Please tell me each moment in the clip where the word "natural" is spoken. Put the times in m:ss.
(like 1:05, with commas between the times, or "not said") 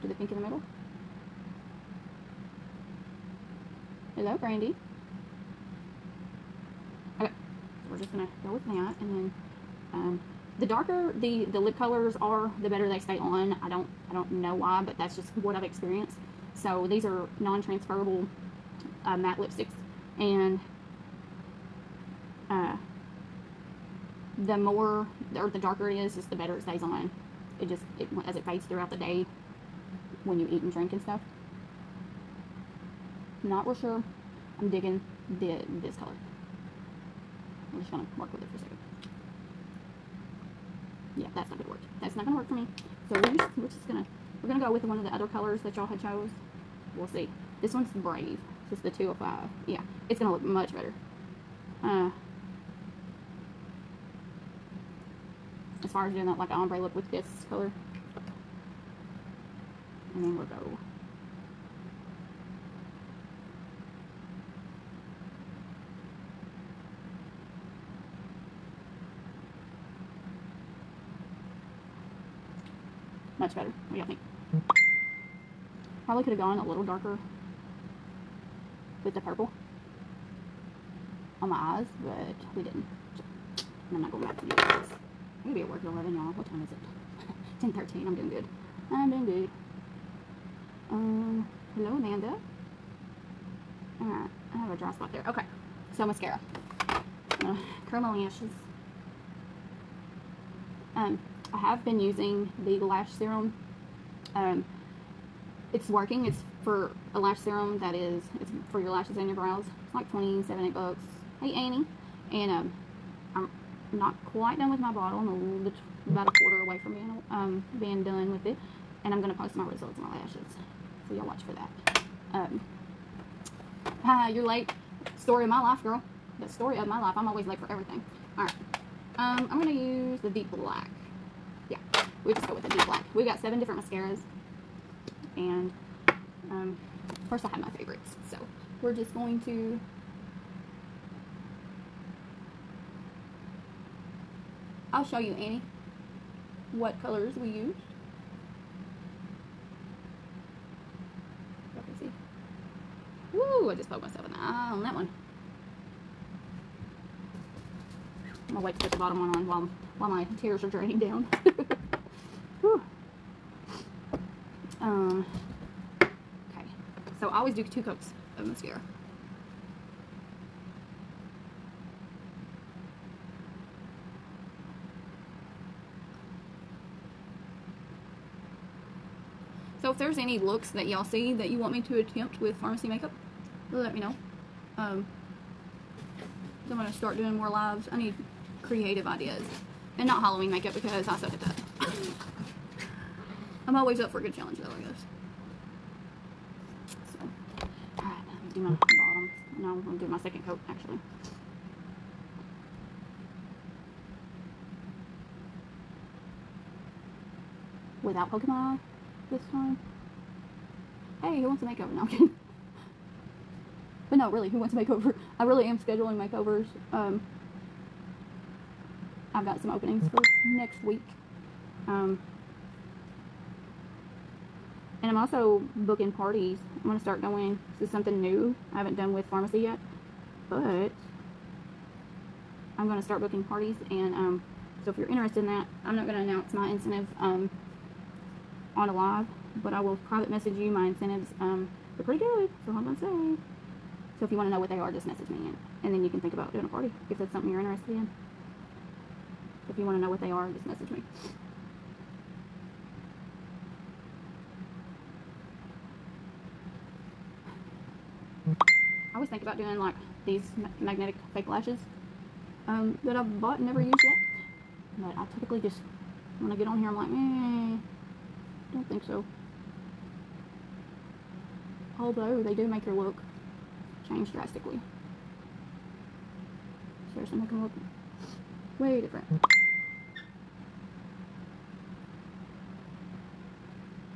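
not said.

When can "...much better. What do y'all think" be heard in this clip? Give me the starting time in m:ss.
1:13.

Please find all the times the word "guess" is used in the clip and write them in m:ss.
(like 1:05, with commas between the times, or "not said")
3:14.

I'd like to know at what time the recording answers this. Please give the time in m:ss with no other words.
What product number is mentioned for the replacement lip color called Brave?
0:48.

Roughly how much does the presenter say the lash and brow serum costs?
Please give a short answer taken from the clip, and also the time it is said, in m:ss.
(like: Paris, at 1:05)
27 or 28 dollars, at 1:50.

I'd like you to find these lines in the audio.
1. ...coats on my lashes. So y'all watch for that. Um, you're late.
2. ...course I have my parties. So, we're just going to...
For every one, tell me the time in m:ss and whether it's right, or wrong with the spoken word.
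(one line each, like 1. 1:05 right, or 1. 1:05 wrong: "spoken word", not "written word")
1. 1:59 wrong: "results", not "coats"
2. 2:17 wrong: "favorites", not "parties".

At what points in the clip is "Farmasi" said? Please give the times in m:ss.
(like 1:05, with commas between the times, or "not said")
3:02, 3:49.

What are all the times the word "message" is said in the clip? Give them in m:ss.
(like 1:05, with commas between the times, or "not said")
4:00, 4:05, 4:10.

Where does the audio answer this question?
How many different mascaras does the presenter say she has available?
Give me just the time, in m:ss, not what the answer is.
2:13.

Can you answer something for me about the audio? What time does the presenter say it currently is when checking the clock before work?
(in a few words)
10:13.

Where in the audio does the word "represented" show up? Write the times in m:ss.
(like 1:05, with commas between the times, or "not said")
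not said.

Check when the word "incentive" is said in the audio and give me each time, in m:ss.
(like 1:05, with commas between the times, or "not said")
3:56, 4:00.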